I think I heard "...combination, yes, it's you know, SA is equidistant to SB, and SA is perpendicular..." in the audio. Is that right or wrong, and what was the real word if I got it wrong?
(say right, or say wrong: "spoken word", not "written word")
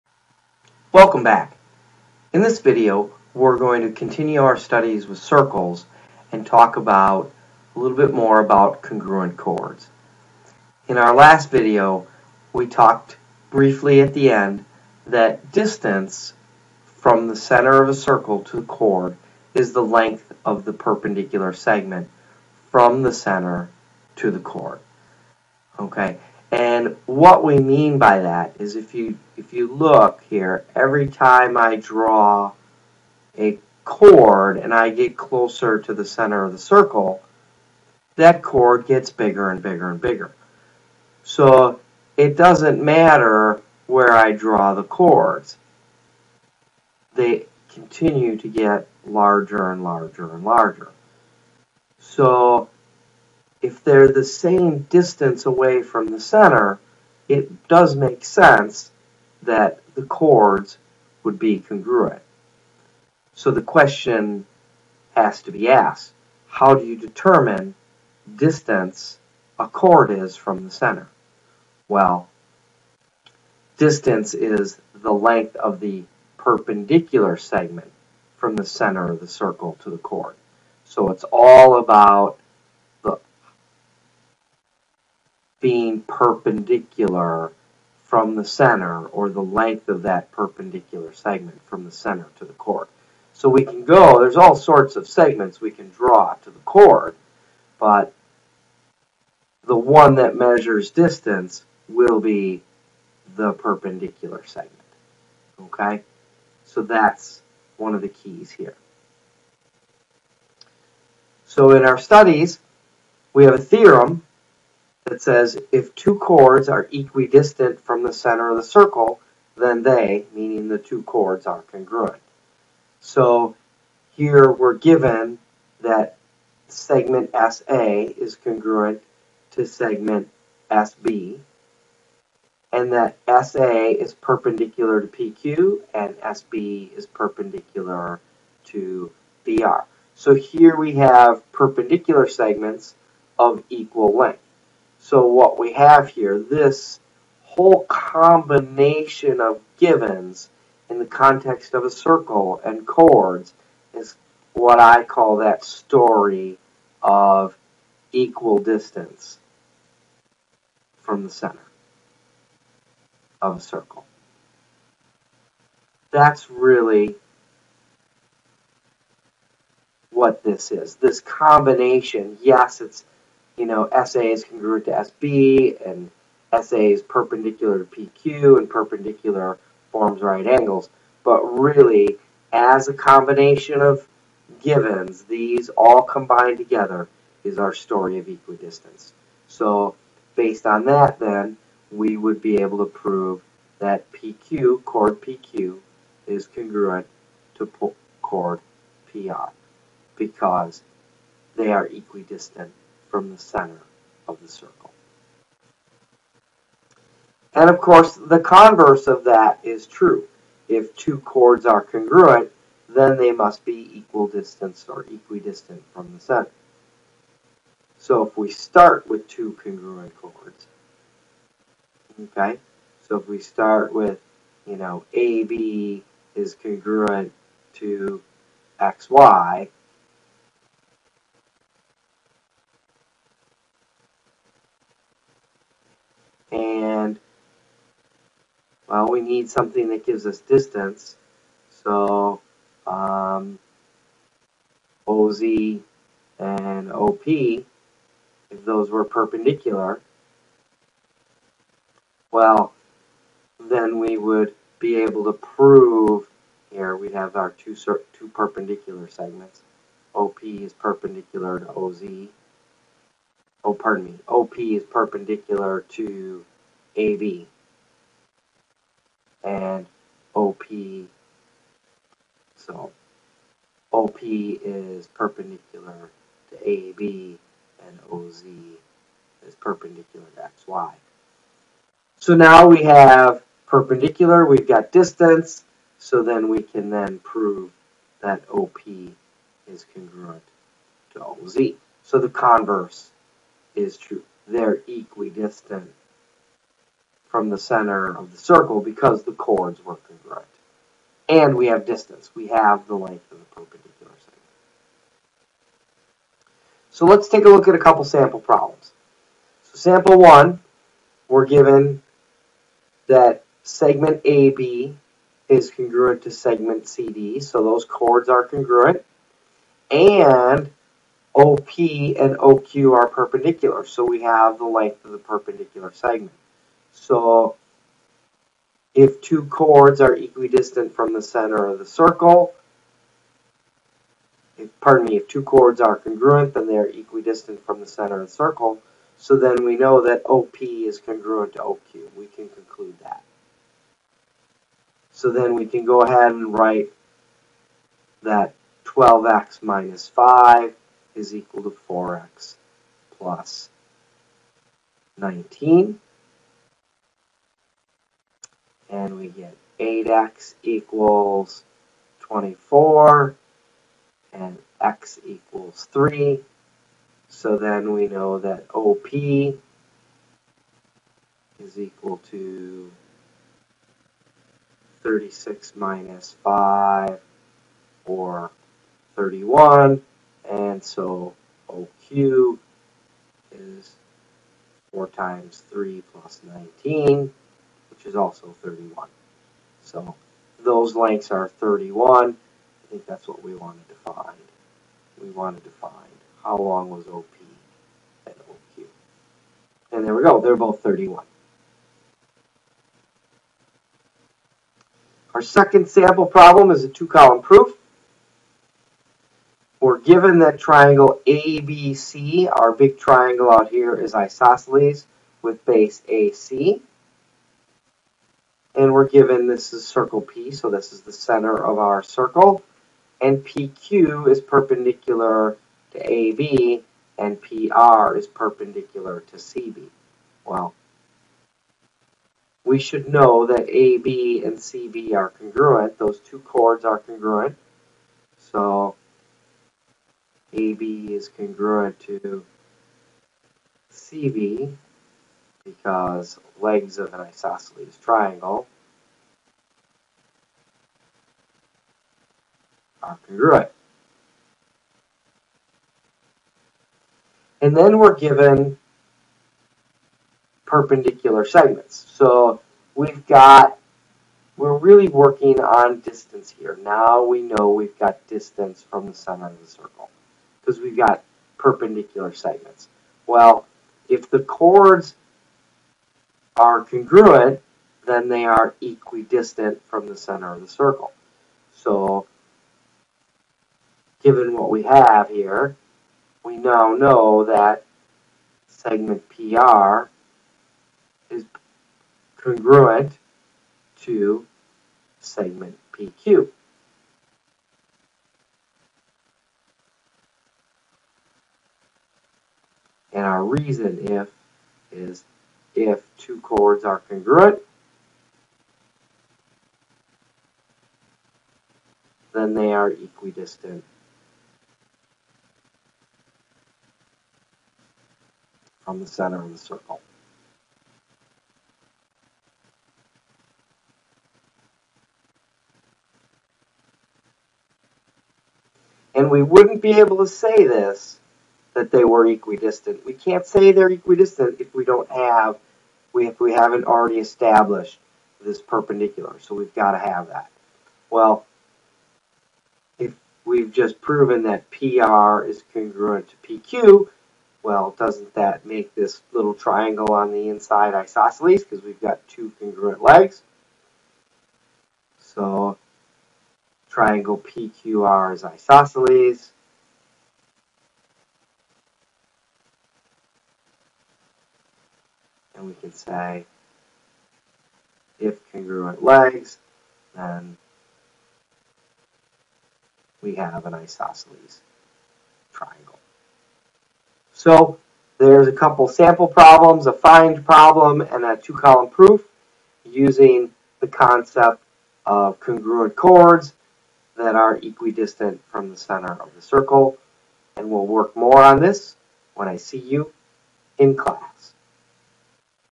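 wrong: "congruent", not "equidistant".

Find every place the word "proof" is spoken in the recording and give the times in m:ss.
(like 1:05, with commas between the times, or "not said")
6:47, 9:41.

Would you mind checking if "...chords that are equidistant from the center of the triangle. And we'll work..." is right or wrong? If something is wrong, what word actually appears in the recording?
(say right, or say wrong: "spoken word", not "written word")
wrong: "circle", not "triangle".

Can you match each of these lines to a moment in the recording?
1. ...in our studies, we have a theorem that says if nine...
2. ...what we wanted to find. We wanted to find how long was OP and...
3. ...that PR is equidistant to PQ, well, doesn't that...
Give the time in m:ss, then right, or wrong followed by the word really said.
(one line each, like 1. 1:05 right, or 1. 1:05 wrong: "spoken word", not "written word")
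1. 1:51 wrong: "two", not "nine"
2. 6:33 right
3. 9:04 wrong: "congruent", not "equidistant".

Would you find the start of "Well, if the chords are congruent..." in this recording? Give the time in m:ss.
7:53.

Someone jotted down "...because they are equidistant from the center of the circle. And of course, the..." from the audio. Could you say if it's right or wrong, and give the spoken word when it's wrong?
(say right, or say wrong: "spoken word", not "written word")
right.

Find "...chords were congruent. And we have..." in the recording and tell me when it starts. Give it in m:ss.
4:59.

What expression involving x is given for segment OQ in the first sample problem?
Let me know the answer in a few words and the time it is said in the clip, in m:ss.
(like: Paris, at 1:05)
4x + 19, at 5:51.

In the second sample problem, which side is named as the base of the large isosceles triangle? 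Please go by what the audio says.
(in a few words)
AC.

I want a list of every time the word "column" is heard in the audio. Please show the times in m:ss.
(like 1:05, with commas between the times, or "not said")
6:46, 9:41.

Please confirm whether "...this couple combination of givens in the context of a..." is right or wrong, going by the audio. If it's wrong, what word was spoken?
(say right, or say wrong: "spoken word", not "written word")
wrong: "whole", not "couple".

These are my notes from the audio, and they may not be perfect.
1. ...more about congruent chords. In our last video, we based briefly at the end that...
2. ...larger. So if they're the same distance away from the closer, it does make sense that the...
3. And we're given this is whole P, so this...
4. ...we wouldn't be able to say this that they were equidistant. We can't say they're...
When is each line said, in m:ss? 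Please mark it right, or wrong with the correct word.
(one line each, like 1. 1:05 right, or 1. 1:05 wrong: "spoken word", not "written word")
1. 0:08 wrong: "talked", not "based"
2. 0:50 wrong: "center", not "closer"
3. 6:58 wrong: "circle", not "whole"
4. 8:49 right.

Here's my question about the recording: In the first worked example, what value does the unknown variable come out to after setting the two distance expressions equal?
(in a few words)
3.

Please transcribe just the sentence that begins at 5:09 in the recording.
So sample one, we're given that segment AB is congruent to segment CD, so those chords are congruent.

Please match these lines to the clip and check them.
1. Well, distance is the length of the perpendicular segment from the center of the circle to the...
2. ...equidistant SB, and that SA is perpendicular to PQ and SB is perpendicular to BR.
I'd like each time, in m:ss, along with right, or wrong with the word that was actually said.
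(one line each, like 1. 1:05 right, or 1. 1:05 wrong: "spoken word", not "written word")
1. 1:11 right
2. 2:09 wrong: "segment", not "equidistant".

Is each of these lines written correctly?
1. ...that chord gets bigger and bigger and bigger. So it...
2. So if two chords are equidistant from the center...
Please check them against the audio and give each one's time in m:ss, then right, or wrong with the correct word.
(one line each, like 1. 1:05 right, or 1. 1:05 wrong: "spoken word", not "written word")
1. 0:38 right
2. 5:26 right.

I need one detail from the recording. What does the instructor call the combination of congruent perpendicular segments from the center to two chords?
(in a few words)
story of equal distance.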